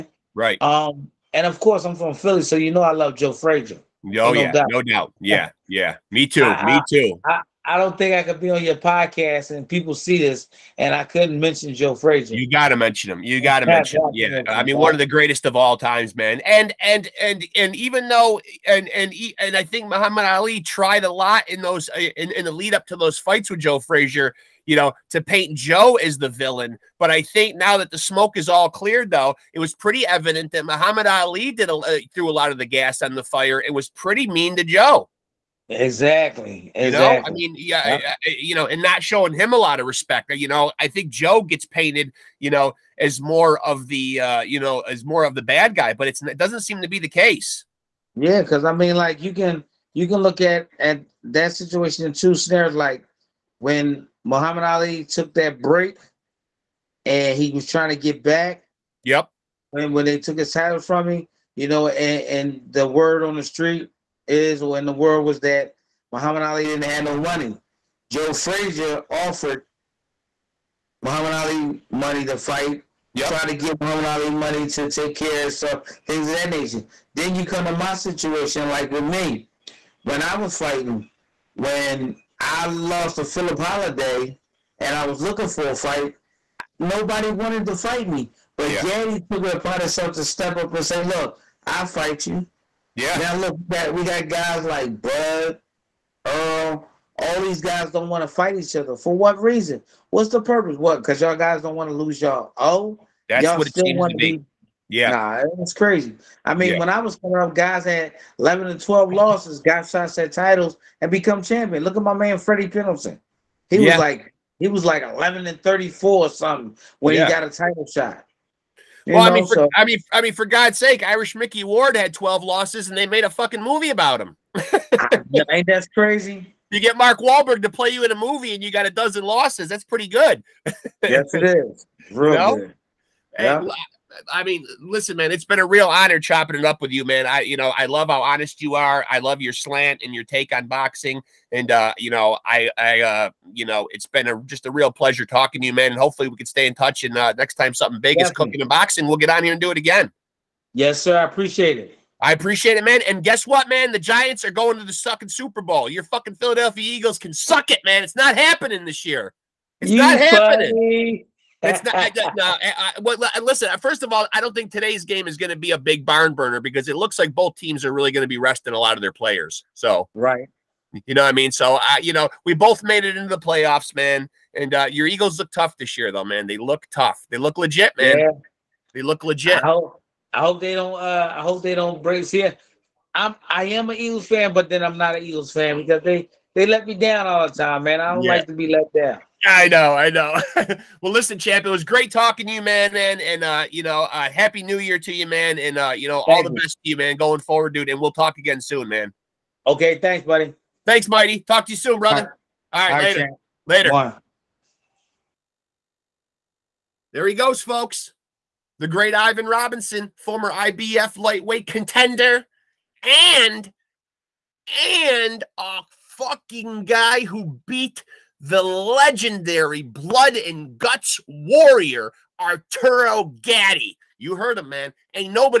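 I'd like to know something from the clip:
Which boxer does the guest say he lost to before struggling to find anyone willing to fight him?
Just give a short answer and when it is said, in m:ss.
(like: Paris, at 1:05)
Philip Holiday, at 1:23.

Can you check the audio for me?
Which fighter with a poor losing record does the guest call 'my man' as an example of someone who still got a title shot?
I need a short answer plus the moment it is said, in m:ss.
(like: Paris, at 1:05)
Freddie Pendleton, at 1:52.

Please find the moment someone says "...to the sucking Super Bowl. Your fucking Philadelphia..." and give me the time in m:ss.
2:34.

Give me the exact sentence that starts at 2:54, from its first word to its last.
And uh, your Eagles look tough this year, though, man.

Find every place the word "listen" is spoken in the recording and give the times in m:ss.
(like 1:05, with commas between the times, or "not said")
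2:14, 2:43, 3:11.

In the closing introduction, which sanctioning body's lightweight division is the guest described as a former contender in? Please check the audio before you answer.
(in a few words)
IBF.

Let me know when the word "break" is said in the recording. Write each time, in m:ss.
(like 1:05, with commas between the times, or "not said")
0:55, 3:02.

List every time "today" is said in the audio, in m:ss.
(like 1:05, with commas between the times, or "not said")
2:44.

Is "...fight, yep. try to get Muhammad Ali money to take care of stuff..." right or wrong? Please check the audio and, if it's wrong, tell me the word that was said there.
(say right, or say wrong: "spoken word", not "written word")
right.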